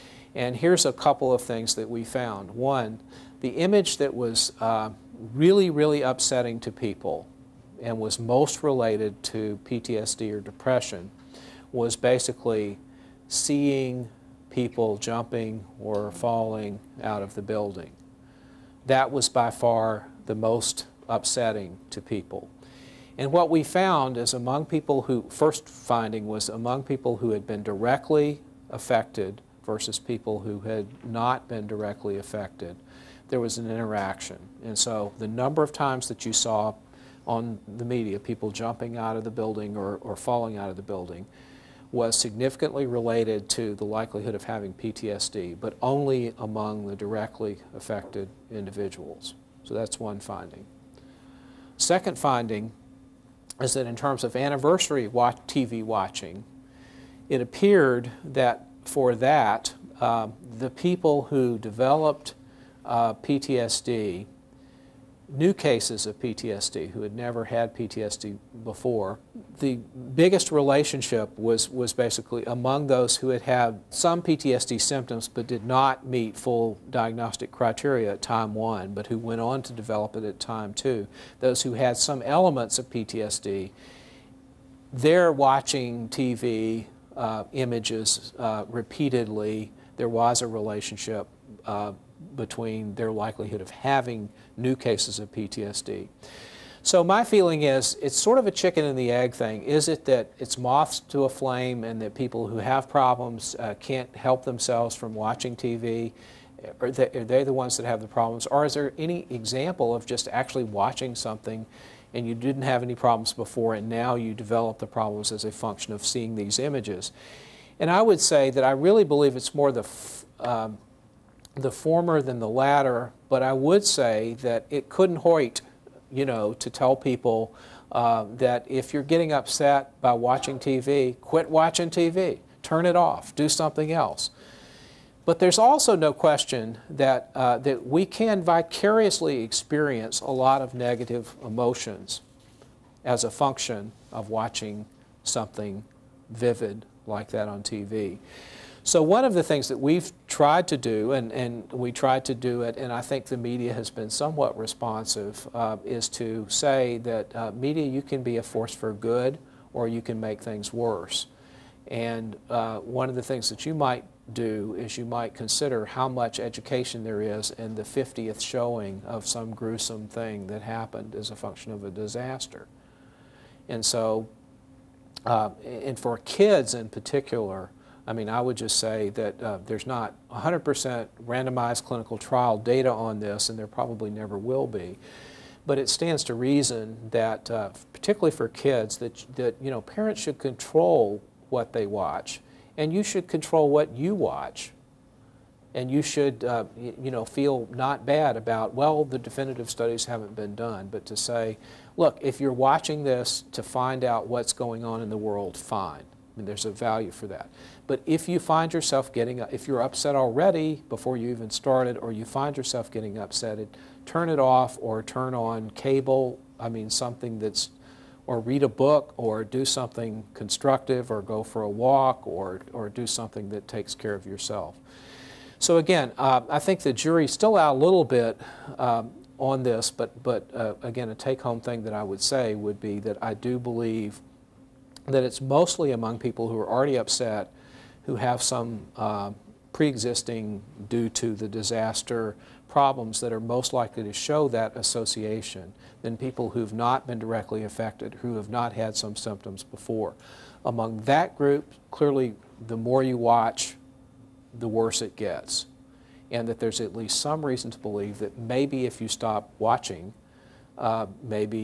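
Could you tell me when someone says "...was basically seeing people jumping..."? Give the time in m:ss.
0:11.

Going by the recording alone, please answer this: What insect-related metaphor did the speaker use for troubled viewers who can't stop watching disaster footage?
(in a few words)
Moths to a flame.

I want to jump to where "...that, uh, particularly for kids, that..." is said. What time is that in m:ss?
3:07.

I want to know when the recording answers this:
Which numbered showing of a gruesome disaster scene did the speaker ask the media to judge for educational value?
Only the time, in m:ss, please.
2:47.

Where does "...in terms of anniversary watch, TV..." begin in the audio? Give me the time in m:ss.
0:53.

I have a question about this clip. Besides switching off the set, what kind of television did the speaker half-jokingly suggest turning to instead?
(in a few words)
Cable.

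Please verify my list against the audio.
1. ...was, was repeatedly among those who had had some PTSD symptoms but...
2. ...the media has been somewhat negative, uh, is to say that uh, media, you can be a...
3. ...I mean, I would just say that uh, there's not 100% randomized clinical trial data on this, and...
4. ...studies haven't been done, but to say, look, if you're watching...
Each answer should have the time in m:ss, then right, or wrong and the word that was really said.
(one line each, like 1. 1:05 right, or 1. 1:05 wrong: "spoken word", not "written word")
1. 1:11 wrong: "basically", not "repeatedly"
2. 2:33 wrong: "responsive", not "negative"
3. 2:58 right
4. 3:19 right.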